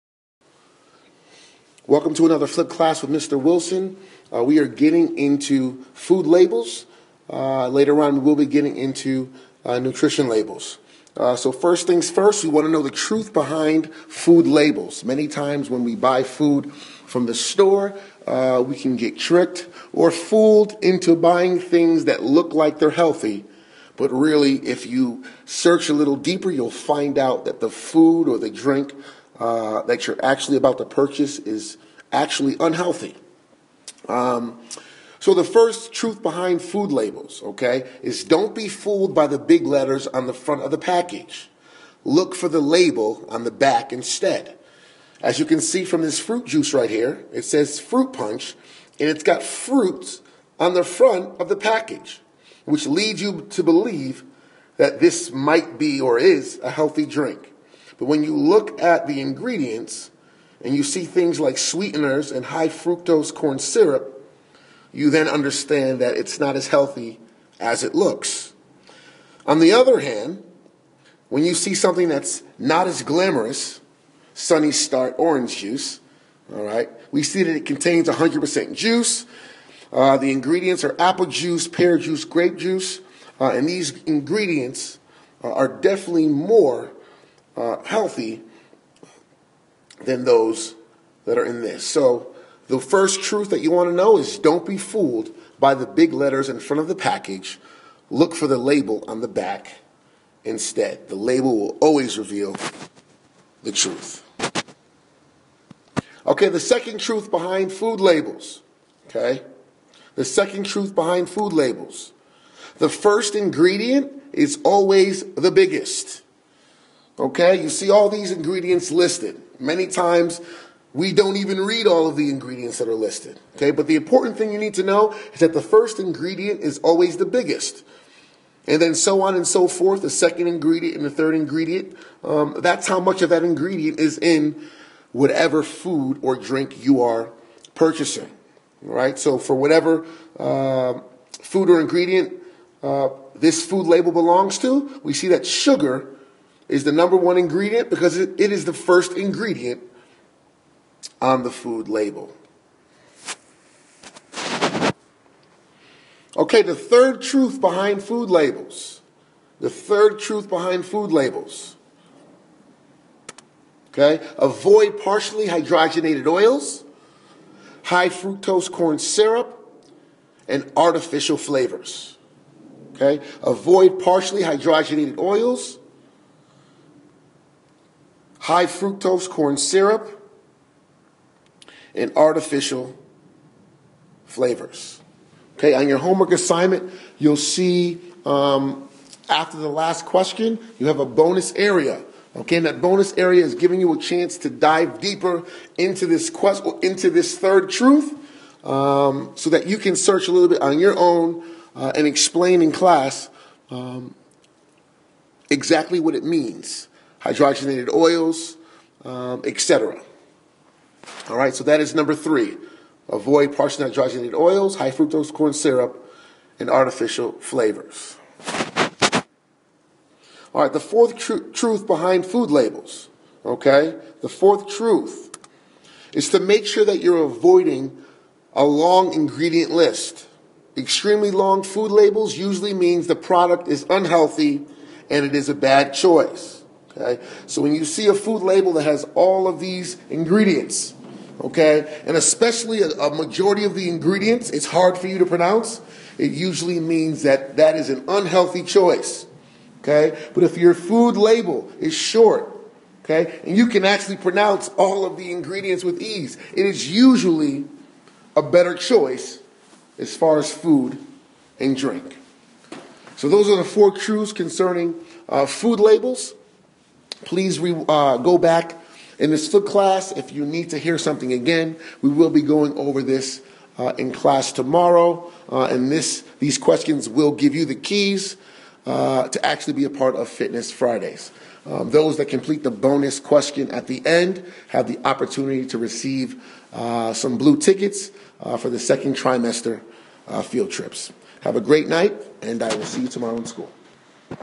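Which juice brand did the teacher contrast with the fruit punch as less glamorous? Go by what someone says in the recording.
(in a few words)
Sunny Start.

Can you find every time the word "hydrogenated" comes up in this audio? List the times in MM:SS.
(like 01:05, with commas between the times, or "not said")
02:45, 02:54, 03:27, 03:33.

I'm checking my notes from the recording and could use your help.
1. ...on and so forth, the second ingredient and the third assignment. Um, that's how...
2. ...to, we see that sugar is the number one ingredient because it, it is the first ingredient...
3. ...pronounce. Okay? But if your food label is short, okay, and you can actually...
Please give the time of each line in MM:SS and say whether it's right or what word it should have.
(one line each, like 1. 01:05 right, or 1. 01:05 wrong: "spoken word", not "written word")
1. 02:09 wrong: "ingredient", not "assignment"
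2. 02:24 right
3. 04:08 wrong: "choice", not "pronounce".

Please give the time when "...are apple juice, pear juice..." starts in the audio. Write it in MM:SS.
01:20.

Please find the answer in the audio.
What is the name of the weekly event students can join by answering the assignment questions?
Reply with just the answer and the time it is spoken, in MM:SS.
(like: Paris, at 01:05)
Fitness Fridays, at 04:40.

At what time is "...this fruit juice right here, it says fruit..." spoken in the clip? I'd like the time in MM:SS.
00:46.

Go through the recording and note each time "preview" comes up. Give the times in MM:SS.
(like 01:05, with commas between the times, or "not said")
not said.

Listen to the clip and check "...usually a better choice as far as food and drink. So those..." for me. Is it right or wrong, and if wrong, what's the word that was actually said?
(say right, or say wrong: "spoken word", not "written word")
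right.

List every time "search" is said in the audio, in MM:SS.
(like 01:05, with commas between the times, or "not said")
00:25, 03:19.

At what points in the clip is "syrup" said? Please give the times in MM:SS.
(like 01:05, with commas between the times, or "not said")
01:03, 02:48, 02:59, 03:35.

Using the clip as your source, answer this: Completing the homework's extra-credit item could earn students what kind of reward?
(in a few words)
Blue tickets.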